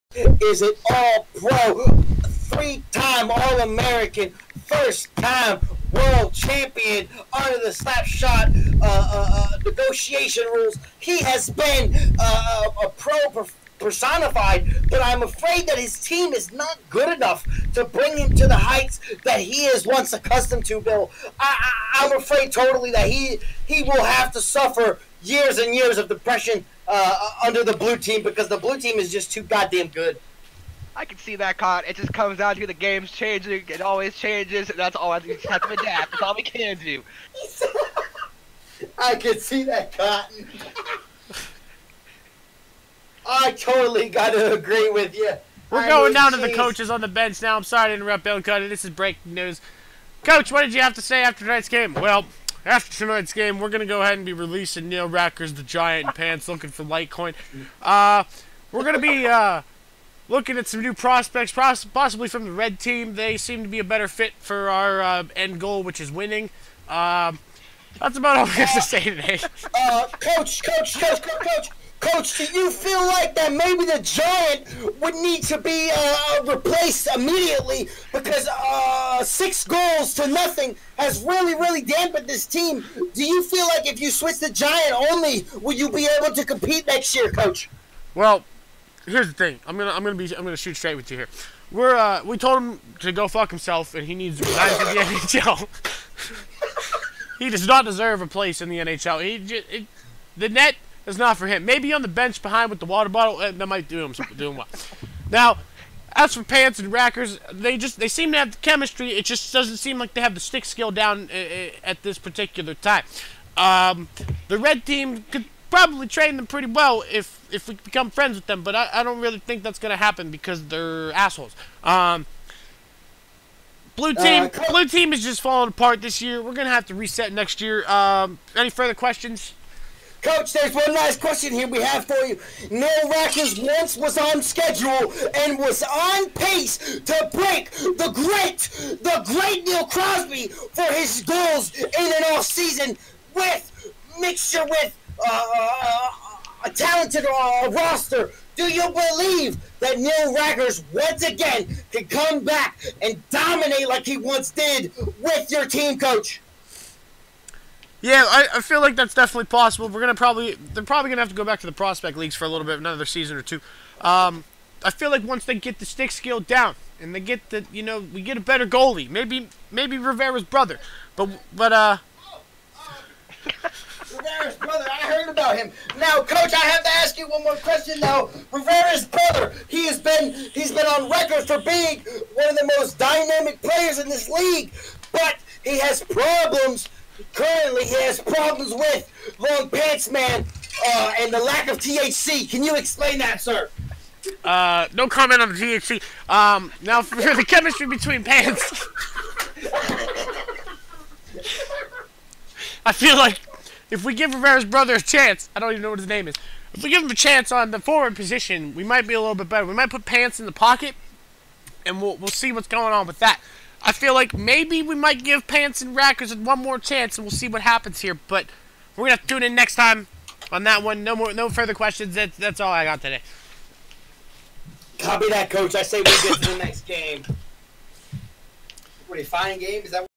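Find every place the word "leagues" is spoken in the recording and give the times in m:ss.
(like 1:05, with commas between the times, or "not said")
2:42, 3:04.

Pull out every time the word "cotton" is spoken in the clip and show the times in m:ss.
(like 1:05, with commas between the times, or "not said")
0:31, 0:39.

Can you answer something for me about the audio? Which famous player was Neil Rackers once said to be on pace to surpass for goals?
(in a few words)
Neil Crosby.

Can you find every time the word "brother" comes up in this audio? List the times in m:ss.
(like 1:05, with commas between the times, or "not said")
2:50, 2:54, 2:59, 3:24.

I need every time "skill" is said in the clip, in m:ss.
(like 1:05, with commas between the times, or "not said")
1:50, 2:46.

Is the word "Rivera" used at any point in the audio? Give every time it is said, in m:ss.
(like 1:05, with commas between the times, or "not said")
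2:49, 2:54, 2:58, 3:24.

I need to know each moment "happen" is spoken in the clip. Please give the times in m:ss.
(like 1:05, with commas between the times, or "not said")
1:59, 3:37.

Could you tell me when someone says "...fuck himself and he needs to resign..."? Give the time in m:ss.
1:33.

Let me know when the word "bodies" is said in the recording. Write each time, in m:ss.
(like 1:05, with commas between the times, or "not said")
not said.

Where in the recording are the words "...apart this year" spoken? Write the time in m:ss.
2:05.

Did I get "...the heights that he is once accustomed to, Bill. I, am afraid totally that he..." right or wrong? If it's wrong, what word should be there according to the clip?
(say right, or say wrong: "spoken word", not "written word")
right.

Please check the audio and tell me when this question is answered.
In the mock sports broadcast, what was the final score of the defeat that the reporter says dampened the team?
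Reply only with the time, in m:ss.
1:19.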